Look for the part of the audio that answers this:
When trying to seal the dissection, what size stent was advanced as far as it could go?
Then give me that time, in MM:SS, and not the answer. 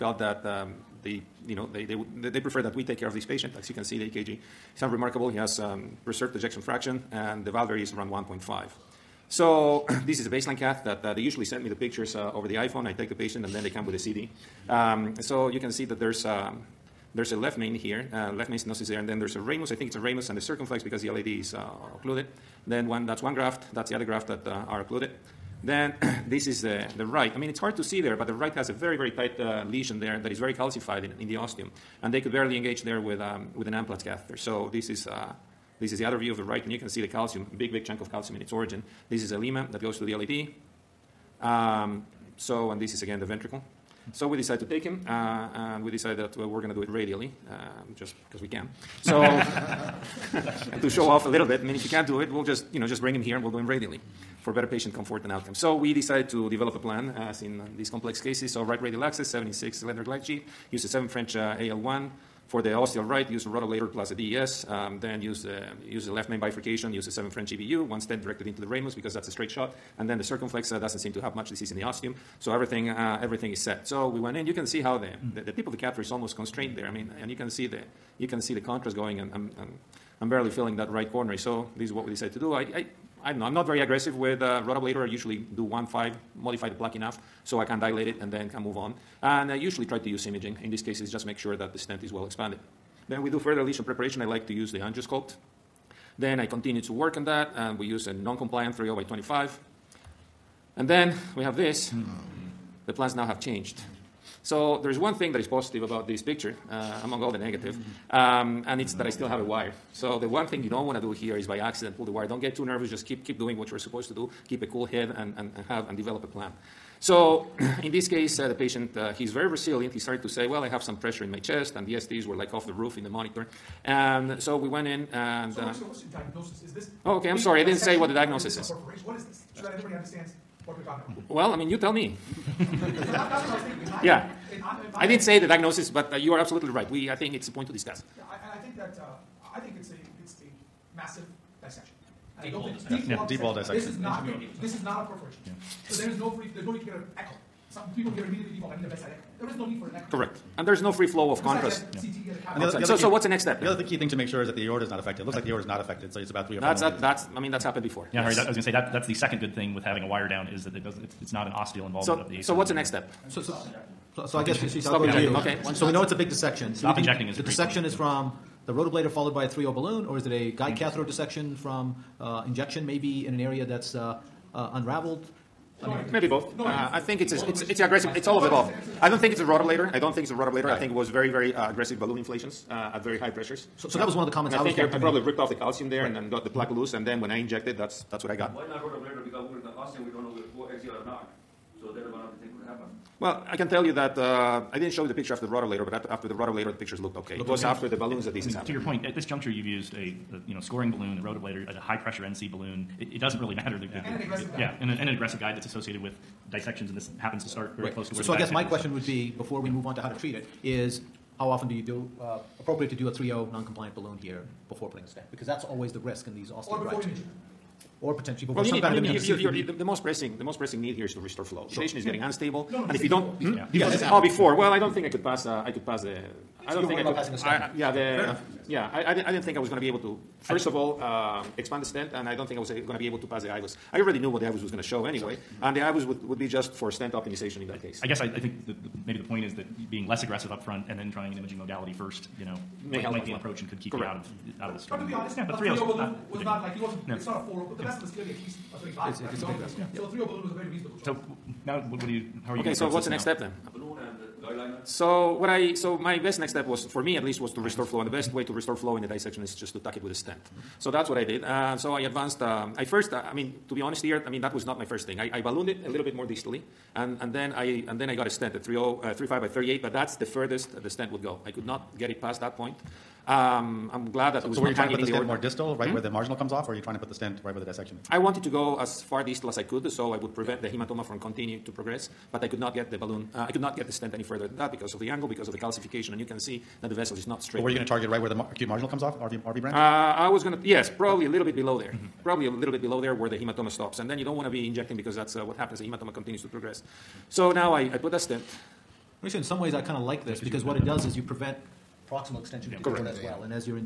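04:29.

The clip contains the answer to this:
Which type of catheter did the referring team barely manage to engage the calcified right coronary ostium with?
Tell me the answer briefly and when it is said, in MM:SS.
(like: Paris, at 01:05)
amplat catheter, at 00:33.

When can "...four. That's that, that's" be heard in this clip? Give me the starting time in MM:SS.
02:36.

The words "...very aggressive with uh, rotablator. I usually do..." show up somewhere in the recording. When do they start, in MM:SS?
01:23.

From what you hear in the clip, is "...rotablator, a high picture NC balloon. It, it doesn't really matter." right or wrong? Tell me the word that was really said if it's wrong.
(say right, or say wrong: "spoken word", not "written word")
wrong: "pressure", not "picture".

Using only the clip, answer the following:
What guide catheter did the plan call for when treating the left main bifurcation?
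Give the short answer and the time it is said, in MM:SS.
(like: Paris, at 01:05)
7 French EBU, at 01:07.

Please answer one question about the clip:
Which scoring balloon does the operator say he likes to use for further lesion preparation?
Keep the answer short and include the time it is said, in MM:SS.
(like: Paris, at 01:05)
angiosculpt, at 01:34.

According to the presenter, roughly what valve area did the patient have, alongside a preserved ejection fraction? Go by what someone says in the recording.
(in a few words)
1.5.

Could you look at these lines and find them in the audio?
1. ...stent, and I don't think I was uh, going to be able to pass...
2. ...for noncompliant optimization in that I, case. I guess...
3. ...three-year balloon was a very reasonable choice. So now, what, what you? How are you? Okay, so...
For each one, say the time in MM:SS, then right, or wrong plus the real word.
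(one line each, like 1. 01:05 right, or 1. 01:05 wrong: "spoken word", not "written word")
1. 03:51 right
2. 03:56 wrong: "stent", not "noncompliant"
3. 04:10 right.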